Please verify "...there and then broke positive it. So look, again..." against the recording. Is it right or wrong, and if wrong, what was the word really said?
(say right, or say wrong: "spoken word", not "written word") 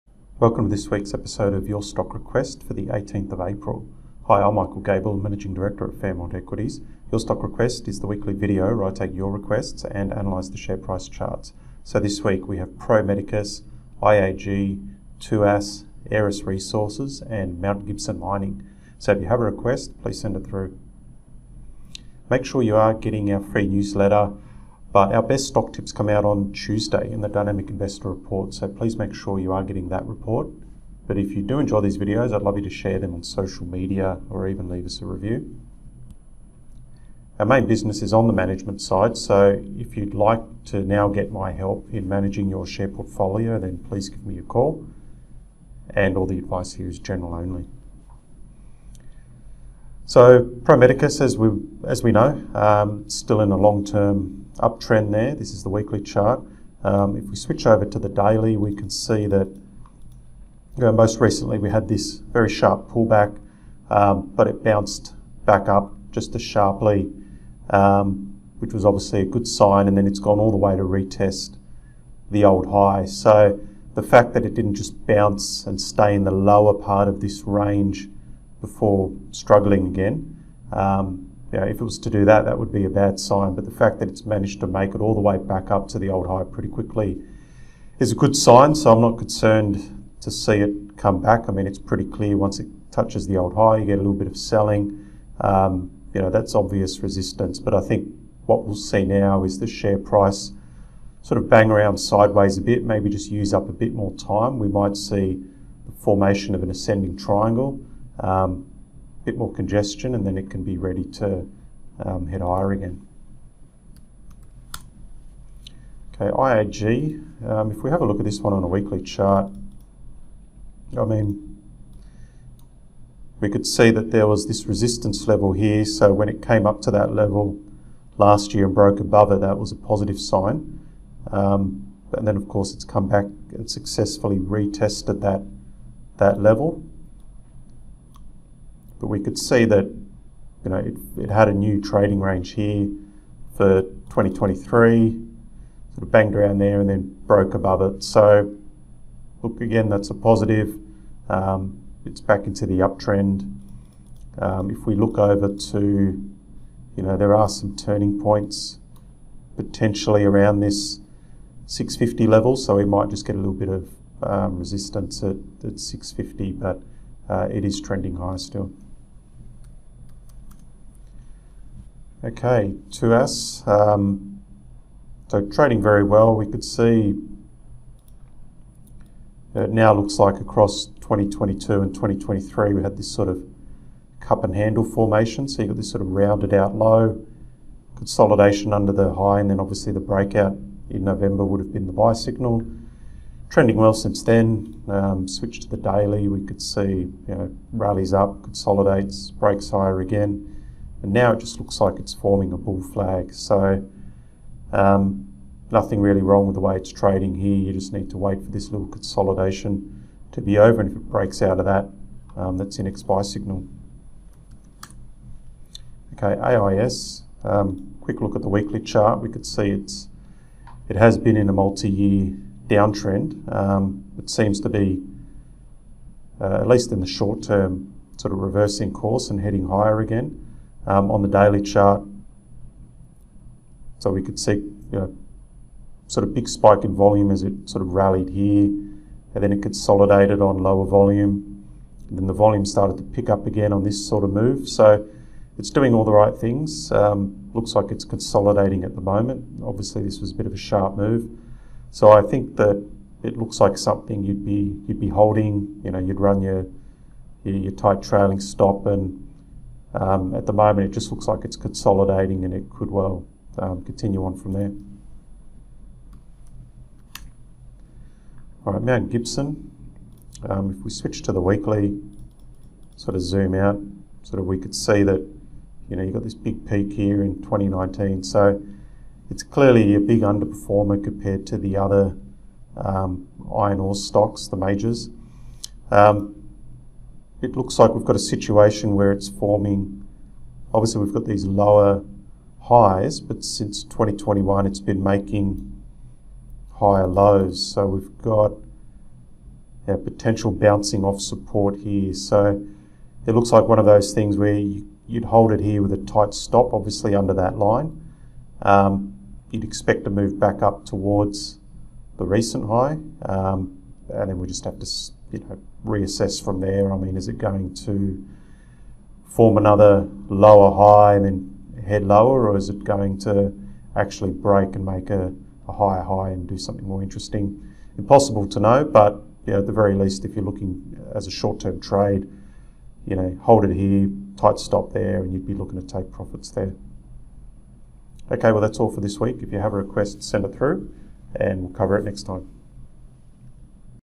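wrong: "above", not "positive".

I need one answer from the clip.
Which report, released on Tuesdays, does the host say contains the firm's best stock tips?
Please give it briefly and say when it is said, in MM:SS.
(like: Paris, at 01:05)
Dynamic Investor Report, at 00:27.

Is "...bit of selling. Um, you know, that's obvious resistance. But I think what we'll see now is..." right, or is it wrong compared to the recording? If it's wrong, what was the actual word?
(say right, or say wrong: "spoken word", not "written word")
right.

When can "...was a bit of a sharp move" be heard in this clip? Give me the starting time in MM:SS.
04:10.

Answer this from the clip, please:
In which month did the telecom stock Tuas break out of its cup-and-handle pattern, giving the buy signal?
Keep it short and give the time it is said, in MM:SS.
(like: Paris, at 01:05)
November, at 03:11.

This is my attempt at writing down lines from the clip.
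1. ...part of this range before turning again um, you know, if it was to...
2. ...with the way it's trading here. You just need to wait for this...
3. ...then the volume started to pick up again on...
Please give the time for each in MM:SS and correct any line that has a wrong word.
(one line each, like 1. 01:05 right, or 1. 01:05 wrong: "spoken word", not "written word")
1. 01:16 wrong: "struggling", not "turning"
2. 03:26 right
3. 04:02 right.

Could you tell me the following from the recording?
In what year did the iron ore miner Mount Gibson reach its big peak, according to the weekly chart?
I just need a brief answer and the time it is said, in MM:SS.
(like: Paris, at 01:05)
2019, at 04:37.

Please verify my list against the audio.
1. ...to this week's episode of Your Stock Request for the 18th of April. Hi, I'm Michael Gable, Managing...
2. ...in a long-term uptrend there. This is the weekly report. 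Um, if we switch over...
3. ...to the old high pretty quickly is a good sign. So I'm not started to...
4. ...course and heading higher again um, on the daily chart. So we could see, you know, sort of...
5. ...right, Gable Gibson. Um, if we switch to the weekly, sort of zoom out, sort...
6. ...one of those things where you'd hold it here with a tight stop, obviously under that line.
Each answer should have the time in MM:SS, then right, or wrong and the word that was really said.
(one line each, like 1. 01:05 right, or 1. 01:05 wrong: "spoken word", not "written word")
1. 00:00 right
2. 00:53 wrong: "chart", not "report"
3. 01:25 wrong: "concerned", not "started"
4. 03:48 right
5. 04:28 wrong: "Mount", not "Gable"
6. 05:03 right.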